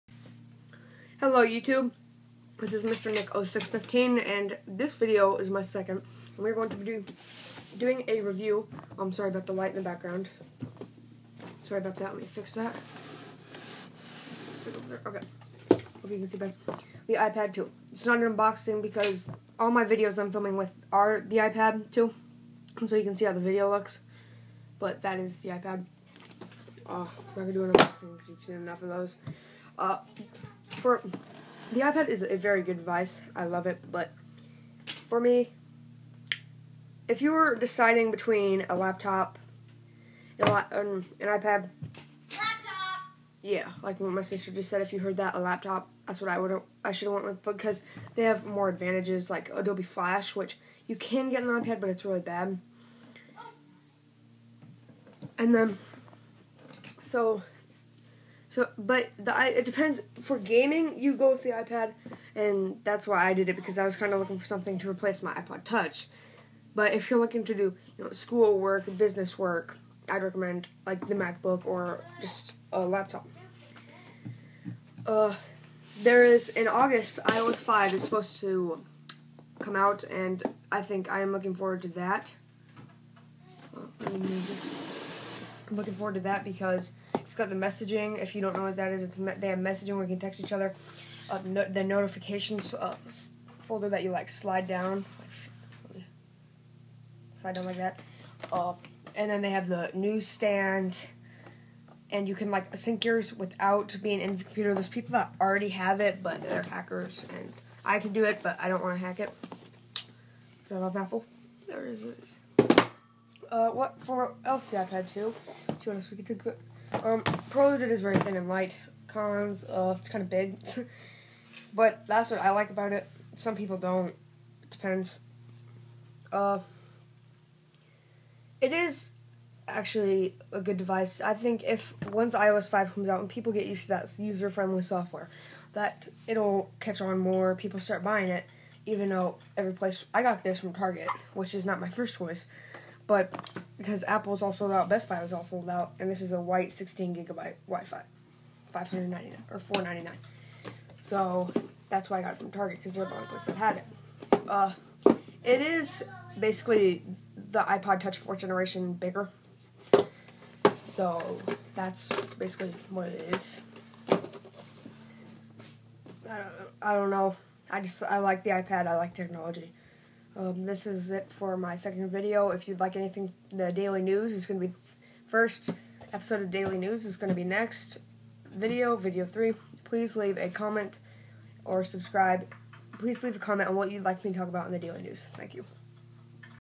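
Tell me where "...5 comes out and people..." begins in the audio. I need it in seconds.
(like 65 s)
132 s.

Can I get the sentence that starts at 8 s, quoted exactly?
Oh, I'm sorry about the light in the background.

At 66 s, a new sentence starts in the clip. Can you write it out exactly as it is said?
But if you're looking to do you know school work, business work, I'd recommend like the MacBook or just a laptop.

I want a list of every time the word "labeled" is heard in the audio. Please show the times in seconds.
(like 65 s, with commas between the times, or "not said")
not said.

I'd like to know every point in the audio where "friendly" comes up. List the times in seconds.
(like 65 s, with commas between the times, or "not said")
134 s.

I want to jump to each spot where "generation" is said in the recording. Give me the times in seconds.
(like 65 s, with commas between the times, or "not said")
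158 s.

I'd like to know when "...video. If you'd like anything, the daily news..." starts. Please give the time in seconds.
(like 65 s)
172 s.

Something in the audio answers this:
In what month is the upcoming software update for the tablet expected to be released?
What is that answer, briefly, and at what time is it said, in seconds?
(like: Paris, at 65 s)
August, at 76 s.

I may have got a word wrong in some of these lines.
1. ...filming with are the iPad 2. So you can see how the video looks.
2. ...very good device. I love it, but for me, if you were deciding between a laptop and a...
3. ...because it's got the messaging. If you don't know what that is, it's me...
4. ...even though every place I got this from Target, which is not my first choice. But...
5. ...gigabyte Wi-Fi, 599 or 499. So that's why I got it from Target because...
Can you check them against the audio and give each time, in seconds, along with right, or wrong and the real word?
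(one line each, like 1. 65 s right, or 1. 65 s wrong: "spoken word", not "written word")
1. 20 s right
2. 32 s right
3. 86 s right
4. 138 s right
5. 147 s right.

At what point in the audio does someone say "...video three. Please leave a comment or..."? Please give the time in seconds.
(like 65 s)
178 s.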